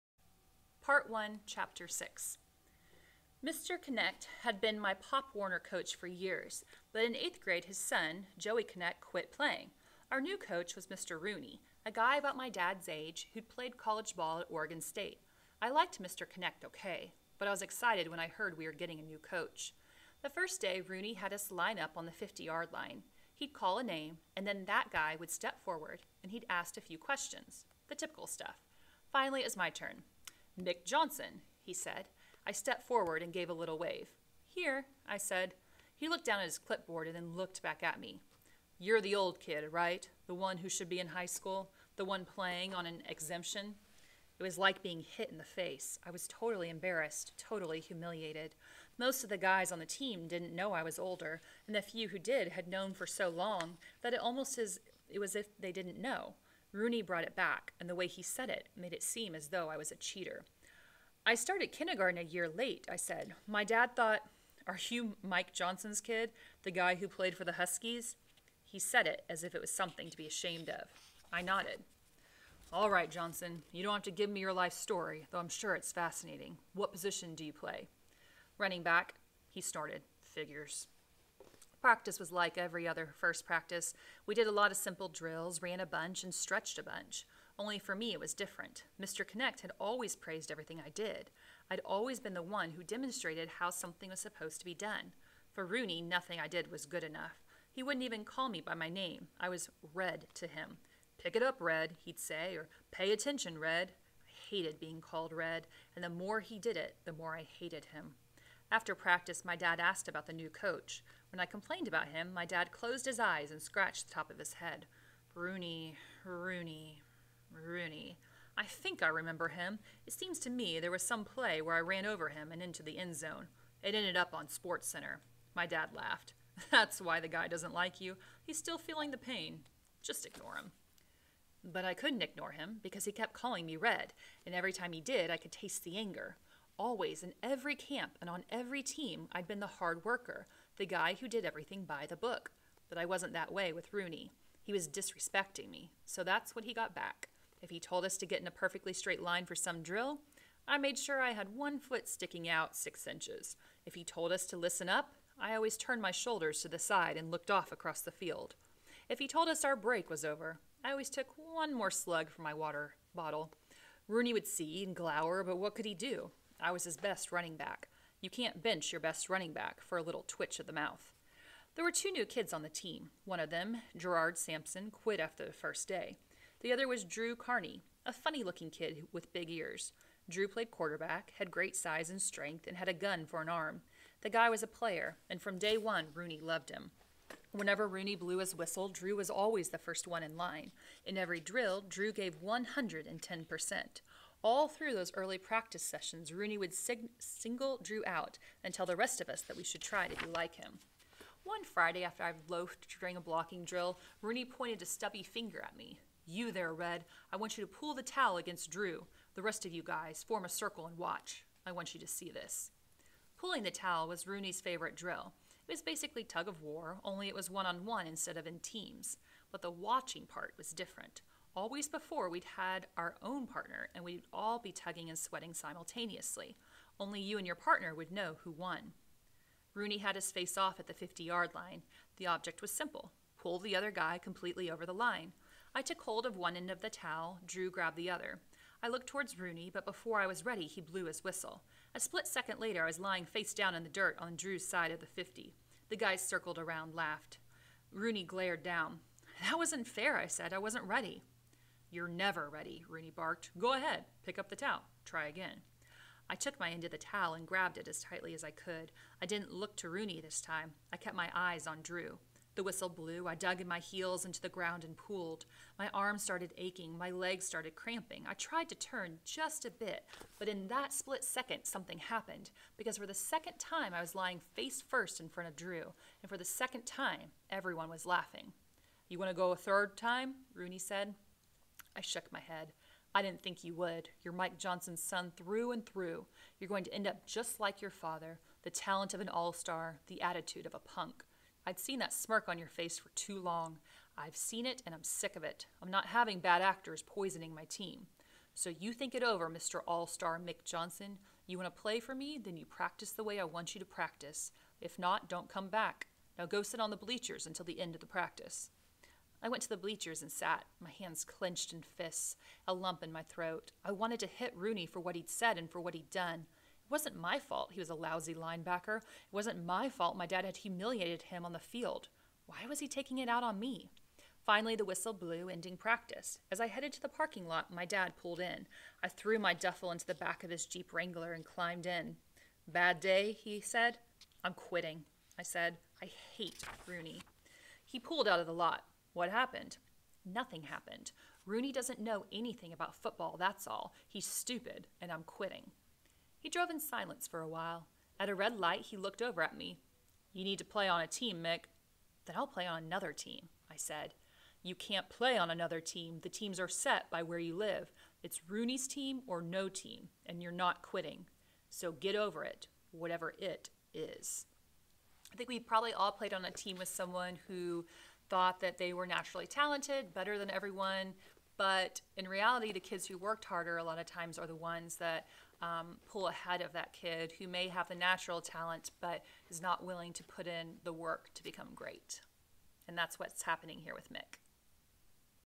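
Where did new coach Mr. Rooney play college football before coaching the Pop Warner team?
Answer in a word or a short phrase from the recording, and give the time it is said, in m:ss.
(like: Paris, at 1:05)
Oregon State, at 0:14.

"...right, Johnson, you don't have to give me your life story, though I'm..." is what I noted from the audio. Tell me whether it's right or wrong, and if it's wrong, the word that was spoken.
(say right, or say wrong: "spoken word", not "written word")
right.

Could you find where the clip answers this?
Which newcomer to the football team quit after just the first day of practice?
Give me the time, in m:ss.
2:53.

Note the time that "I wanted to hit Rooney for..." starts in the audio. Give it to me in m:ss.
5:13.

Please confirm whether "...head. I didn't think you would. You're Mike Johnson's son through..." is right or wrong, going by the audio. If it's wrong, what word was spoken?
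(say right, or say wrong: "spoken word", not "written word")
right.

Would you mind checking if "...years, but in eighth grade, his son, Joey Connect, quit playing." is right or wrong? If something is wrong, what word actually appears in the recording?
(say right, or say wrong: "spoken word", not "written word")
right.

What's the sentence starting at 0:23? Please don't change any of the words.
He'd call a name, and then that guy would step forward and he'd ask a few questions the typical stuff.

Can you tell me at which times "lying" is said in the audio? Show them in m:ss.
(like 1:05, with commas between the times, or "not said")
4:02, 4:34.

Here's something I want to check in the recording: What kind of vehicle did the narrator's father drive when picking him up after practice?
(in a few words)
Jeep Wrangler.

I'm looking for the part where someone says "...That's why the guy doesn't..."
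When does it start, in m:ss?
2:06.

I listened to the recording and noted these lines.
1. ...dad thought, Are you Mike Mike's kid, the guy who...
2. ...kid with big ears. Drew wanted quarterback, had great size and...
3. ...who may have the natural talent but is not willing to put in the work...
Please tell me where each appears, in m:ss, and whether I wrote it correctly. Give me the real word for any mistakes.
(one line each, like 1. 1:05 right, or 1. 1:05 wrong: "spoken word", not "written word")
1. 1:03 wrong: "Johnson", not "Mike"
2. 2:58 wrong: "played", not "wanted"
3. 6:17 right.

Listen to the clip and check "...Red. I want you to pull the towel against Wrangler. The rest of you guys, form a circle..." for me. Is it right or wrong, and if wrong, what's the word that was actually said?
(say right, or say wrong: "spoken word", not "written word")
wrong: "Drew", not "Wrangler".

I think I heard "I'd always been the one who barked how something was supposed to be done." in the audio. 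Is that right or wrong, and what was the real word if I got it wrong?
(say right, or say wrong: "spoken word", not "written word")
wrong: "demonstrated", not "barked".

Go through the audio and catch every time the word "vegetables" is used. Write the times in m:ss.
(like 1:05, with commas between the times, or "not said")
not said.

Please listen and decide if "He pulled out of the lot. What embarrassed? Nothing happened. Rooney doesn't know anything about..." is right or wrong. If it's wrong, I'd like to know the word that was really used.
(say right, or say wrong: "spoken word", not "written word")
wrong: "happened", not "embarrassed".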